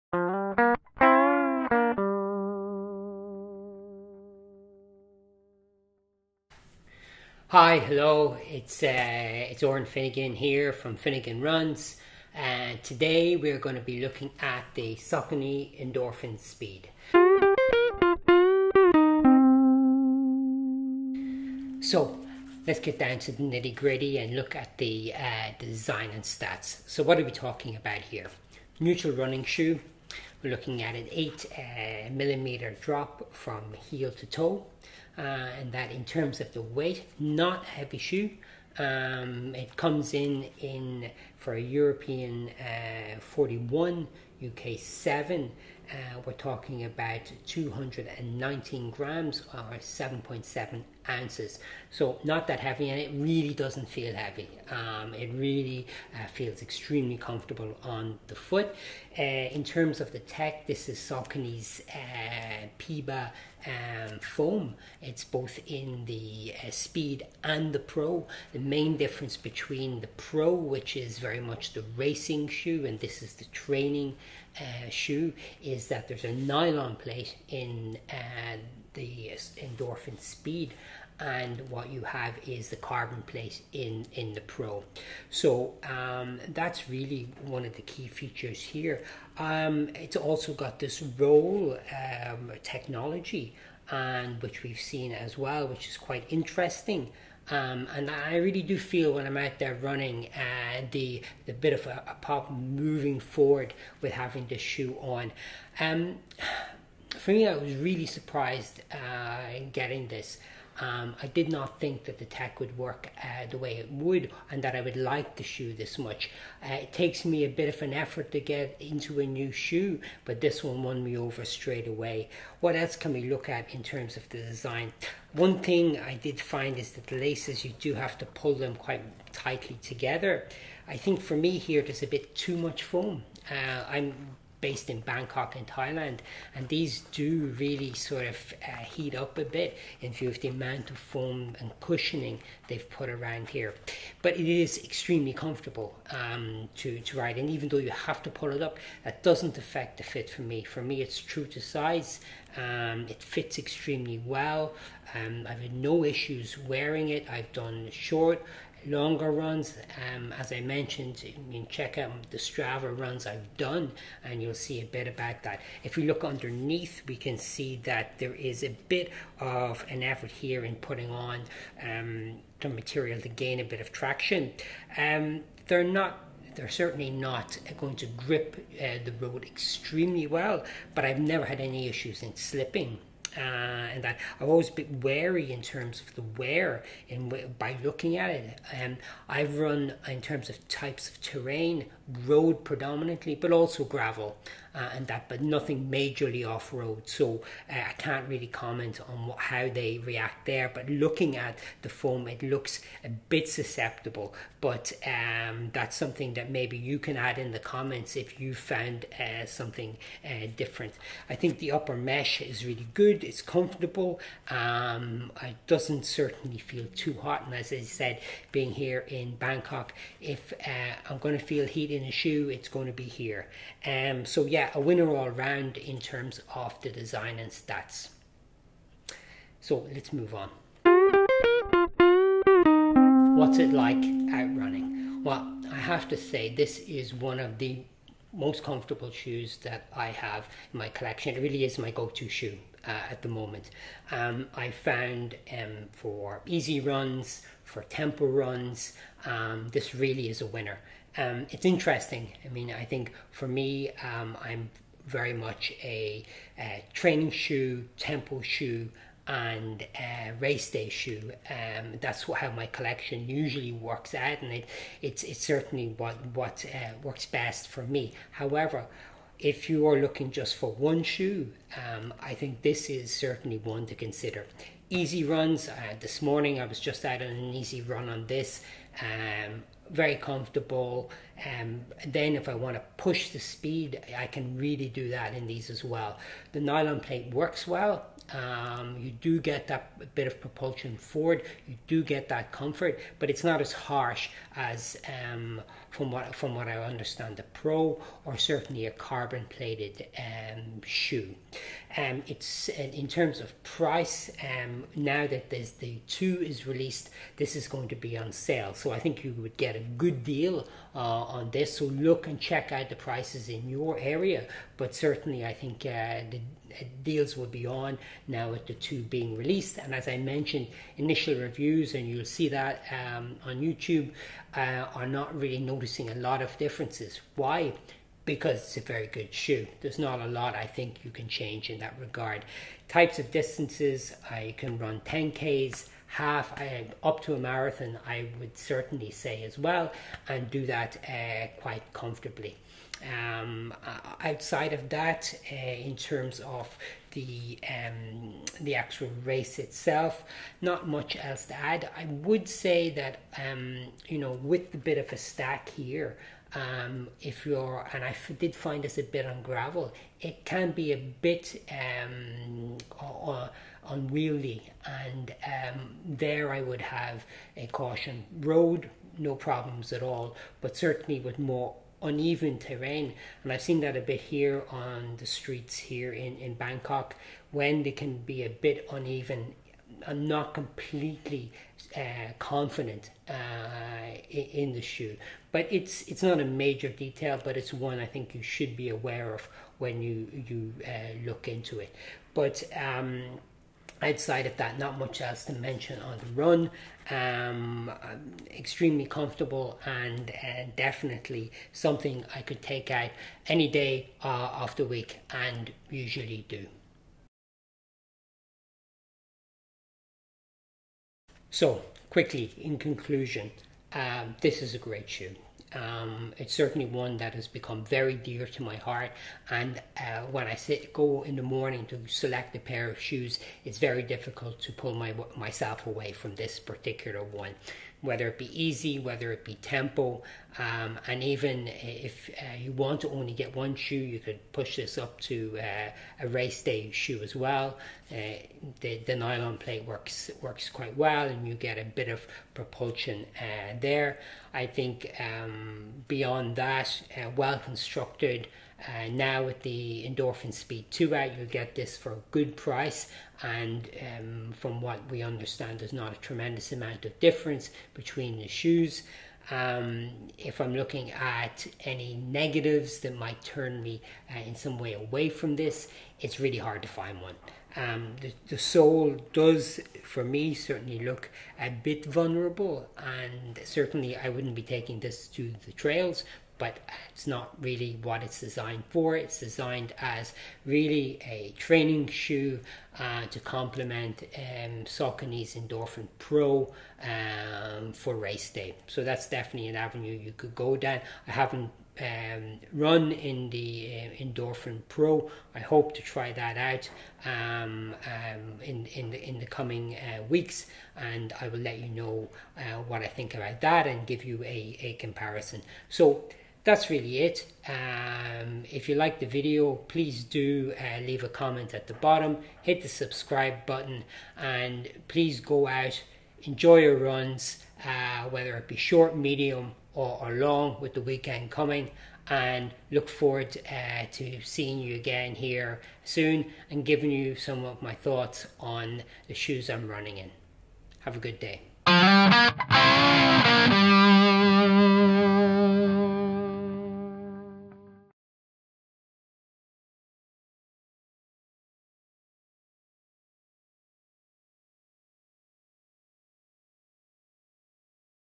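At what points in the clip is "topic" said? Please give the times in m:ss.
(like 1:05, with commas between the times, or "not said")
not said.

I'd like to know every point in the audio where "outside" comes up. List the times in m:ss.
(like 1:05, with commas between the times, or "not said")
5:44, 6:34.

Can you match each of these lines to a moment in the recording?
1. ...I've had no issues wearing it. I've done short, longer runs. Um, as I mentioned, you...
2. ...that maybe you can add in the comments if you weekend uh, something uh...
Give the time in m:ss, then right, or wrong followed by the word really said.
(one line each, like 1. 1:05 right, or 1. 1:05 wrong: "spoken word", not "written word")
1. 2:35 right
2. 3:26 wrong: "found", not "weekend".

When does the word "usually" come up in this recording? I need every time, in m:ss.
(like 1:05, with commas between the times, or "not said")
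4:23, 6:45.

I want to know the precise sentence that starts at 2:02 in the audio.
What else can we look at in terms of the design?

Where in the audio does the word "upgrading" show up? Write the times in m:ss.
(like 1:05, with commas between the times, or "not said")
not said.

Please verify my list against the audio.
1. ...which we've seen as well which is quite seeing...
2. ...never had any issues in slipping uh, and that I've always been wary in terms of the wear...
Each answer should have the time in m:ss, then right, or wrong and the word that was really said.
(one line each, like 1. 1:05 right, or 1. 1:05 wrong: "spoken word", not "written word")
1. 1:34 wrong: "interesting", not "seeing"
2. 3:01 right.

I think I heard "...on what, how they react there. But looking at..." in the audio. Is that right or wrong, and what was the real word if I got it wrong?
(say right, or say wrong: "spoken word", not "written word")
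right.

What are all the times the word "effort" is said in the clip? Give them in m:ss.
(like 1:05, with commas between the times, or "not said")
1:57, 2:50.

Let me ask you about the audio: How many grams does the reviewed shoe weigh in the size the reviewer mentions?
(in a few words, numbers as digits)
219 grams.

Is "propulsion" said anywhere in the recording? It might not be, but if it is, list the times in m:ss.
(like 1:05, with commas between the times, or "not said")
4:50, 7:22.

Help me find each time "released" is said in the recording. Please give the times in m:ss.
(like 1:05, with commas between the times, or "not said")
5:06, 5:19.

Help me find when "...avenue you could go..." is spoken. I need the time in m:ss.
8:09.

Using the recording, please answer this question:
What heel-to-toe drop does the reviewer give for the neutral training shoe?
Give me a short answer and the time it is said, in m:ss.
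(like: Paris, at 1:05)
8 millimeter, at 0:31.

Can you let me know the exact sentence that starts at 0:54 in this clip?
Um, it really uh, feels extremely comfortable on the foot.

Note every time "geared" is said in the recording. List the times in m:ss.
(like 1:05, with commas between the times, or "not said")
not said.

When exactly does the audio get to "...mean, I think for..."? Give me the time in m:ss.
4:12.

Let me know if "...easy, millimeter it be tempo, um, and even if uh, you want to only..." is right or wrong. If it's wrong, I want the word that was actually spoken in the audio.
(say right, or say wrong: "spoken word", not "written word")
wrong: "whether", not "millimeter".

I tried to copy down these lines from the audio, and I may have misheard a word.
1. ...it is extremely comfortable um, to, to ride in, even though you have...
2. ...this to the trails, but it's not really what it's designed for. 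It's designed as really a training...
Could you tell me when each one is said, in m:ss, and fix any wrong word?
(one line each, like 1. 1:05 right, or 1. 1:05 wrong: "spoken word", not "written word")
1. 2:24 right
2. 7:54 right.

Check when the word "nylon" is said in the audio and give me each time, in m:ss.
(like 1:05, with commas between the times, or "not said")
1:16, 4:46, 7:19.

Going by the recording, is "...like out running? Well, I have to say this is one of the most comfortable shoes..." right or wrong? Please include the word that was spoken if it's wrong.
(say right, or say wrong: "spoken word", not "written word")
right.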